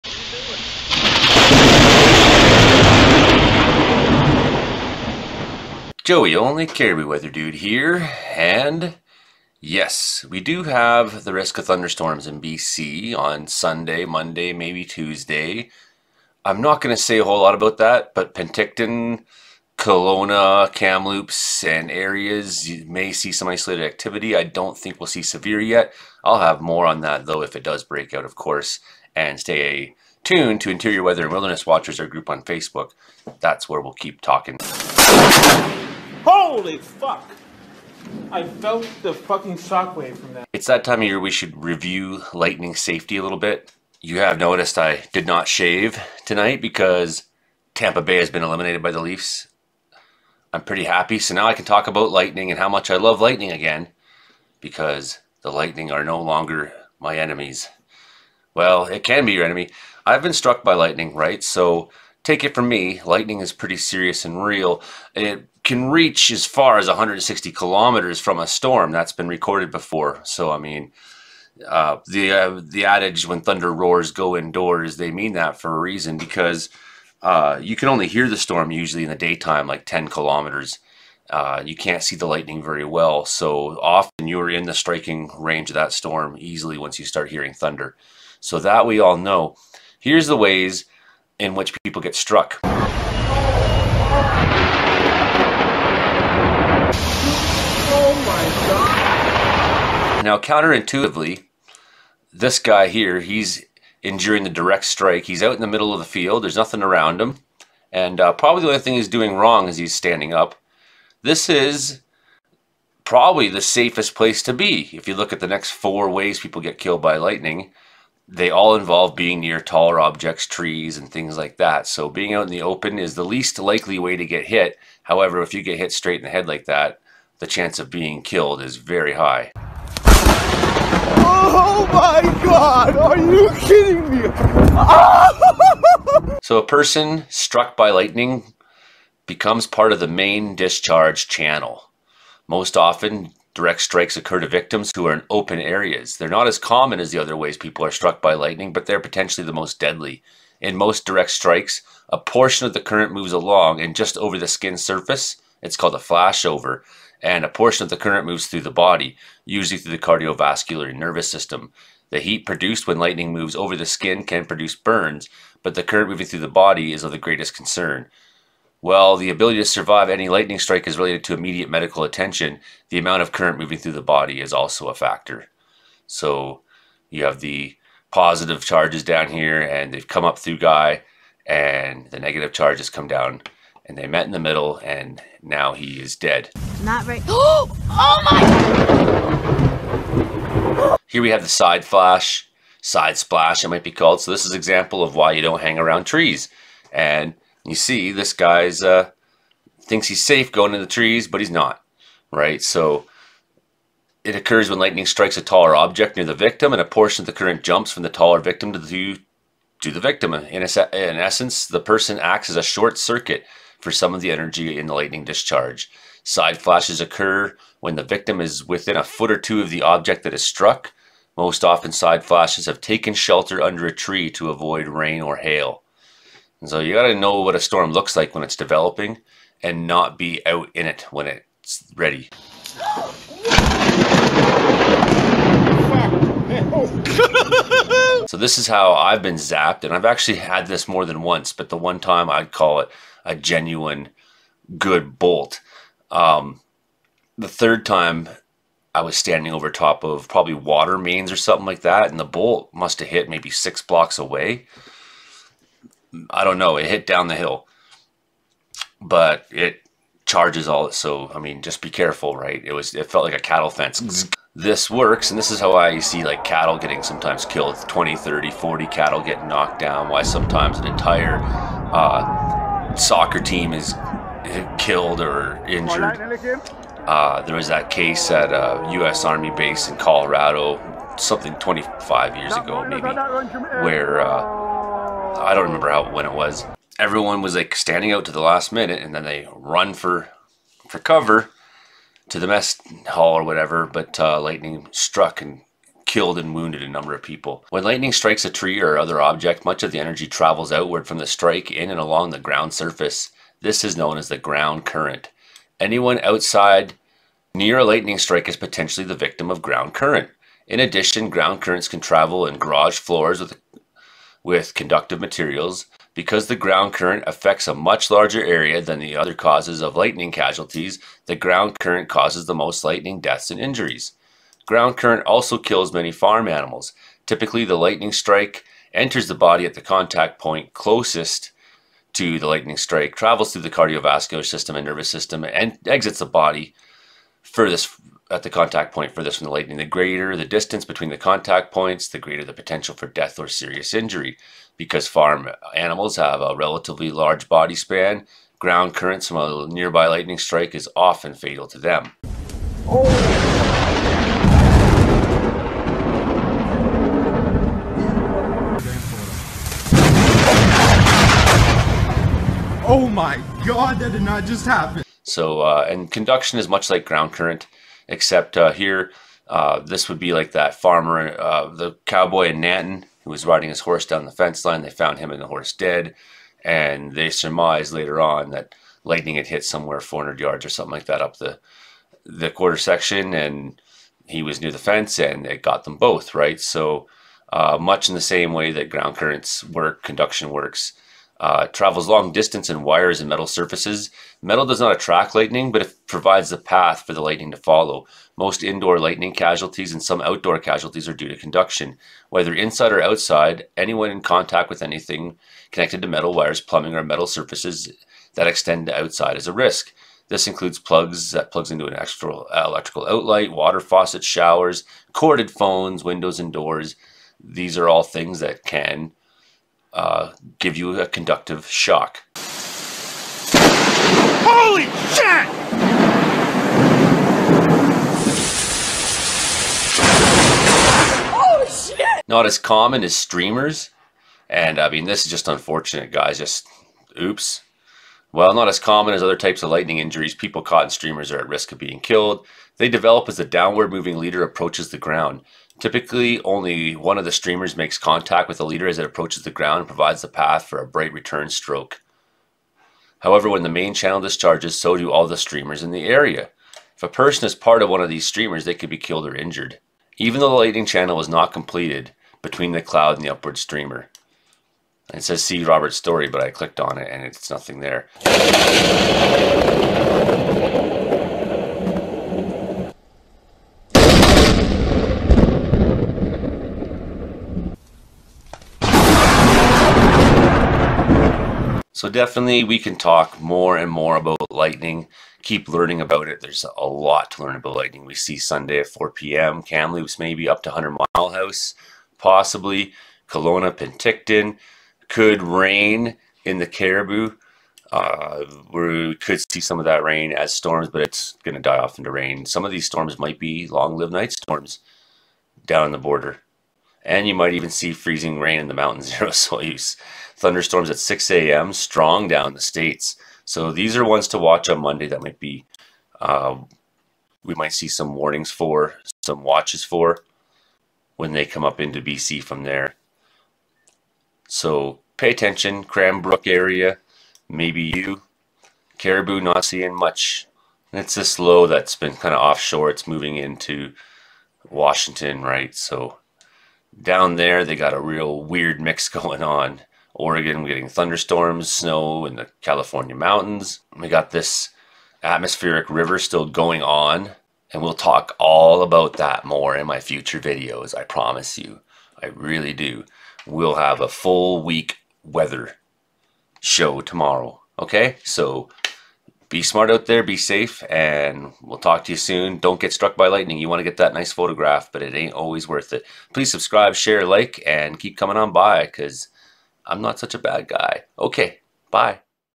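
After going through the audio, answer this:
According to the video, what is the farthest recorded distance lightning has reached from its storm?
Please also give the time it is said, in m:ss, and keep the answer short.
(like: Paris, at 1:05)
160 kilometers, at 1:06.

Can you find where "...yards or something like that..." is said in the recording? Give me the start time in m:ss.
6:20.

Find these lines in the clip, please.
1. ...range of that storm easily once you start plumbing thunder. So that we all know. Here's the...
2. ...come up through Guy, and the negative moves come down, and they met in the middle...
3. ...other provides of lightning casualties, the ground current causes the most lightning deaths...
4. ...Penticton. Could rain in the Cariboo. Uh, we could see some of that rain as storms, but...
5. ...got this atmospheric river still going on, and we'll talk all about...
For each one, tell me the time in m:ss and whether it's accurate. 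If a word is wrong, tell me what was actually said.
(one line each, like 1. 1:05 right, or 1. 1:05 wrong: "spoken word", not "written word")
1. 1:25 wrong: "hearing", not "plumbing"
2. 3:00 wrong: "charges", not "moves"
3. 5:19 wrong: "causes", not "provides"
4. 8:13 right
5. 9:04 right.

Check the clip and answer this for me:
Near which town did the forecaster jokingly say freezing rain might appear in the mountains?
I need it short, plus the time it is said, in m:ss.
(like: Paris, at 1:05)
Osoyoos, at 8:29.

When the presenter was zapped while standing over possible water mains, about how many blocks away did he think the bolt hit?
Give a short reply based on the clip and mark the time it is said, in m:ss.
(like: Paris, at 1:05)
6 blocks, at 4:13.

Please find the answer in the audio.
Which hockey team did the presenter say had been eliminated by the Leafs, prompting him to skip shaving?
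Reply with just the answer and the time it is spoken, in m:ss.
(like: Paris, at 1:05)
Tampa Bay, at 0:47.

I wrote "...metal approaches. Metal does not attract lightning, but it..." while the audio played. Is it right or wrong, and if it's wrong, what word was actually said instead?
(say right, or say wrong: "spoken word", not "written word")
wrong: "surfaces", not "approaches".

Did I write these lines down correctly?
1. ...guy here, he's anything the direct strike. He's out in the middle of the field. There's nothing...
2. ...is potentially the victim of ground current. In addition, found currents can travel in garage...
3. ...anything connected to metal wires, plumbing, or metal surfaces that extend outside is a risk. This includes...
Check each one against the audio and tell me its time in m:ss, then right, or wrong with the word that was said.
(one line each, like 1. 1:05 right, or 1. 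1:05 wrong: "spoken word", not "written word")
1. 1:42 wrong: "enduring", not "anything"
2. 5:08 wrong: "ground", not "found"
3. 6:44 right.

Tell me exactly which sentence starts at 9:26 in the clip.
Please subscribe, share, like, and keep coming on by because I'm not such a bad guy.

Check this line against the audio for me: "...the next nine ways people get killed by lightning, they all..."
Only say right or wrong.
wrong.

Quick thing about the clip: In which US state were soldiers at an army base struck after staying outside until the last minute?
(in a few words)
Colorado.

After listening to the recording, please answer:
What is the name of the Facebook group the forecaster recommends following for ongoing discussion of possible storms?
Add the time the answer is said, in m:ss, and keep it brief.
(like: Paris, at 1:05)
Interior Weather and Wilderness Watchers, at 0:30.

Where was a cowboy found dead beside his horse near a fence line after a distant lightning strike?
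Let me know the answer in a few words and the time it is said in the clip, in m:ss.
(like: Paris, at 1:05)
Nanton, at 6:12.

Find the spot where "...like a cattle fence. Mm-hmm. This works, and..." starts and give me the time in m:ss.
4:23.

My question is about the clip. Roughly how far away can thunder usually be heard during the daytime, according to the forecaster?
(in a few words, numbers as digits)
10 kilometers.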